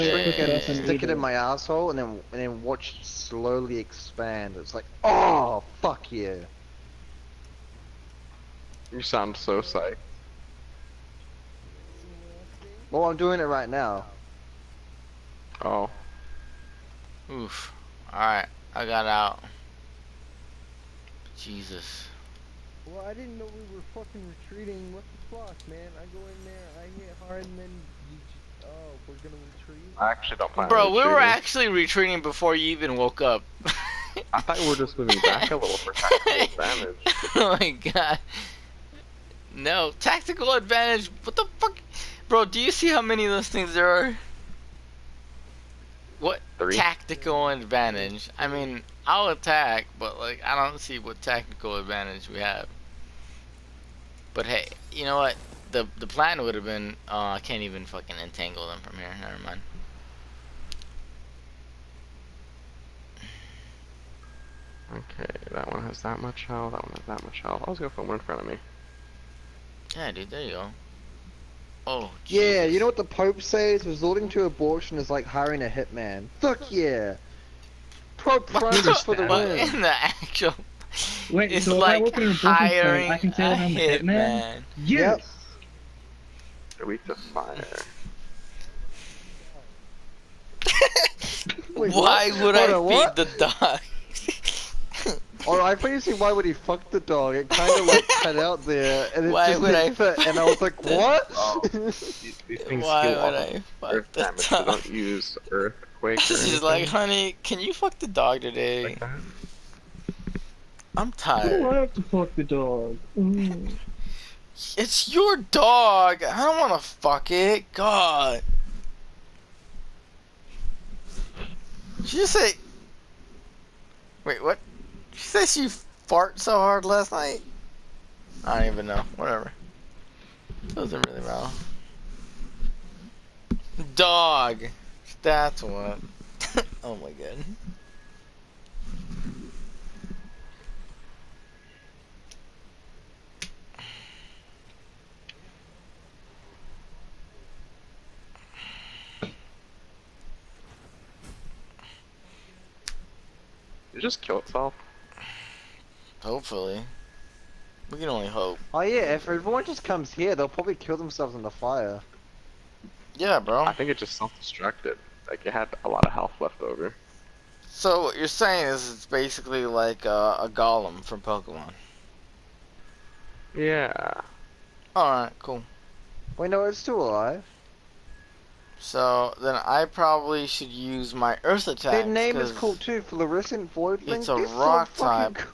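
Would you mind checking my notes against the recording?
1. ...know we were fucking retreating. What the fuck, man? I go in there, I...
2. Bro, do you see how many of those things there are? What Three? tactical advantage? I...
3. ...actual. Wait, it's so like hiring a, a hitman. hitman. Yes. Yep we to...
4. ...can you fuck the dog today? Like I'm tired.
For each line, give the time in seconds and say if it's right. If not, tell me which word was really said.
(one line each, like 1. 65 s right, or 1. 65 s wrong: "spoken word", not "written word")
1. 23 s right
2. 42 s right
3. 79 s right
4. 107 s right.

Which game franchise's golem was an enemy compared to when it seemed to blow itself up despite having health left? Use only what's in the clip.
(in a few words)
Pokemon.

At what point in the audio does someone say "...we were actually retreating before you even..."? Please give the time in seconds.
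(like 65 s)
30 s.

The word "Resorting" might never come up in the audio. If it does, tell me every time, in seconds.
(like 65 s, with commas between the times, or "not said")
73 s.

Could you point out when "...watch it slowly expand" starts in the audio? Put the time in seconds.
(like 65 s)
2 s.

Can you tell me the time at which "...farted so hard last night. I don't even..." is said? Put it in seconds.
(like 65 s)
126 s.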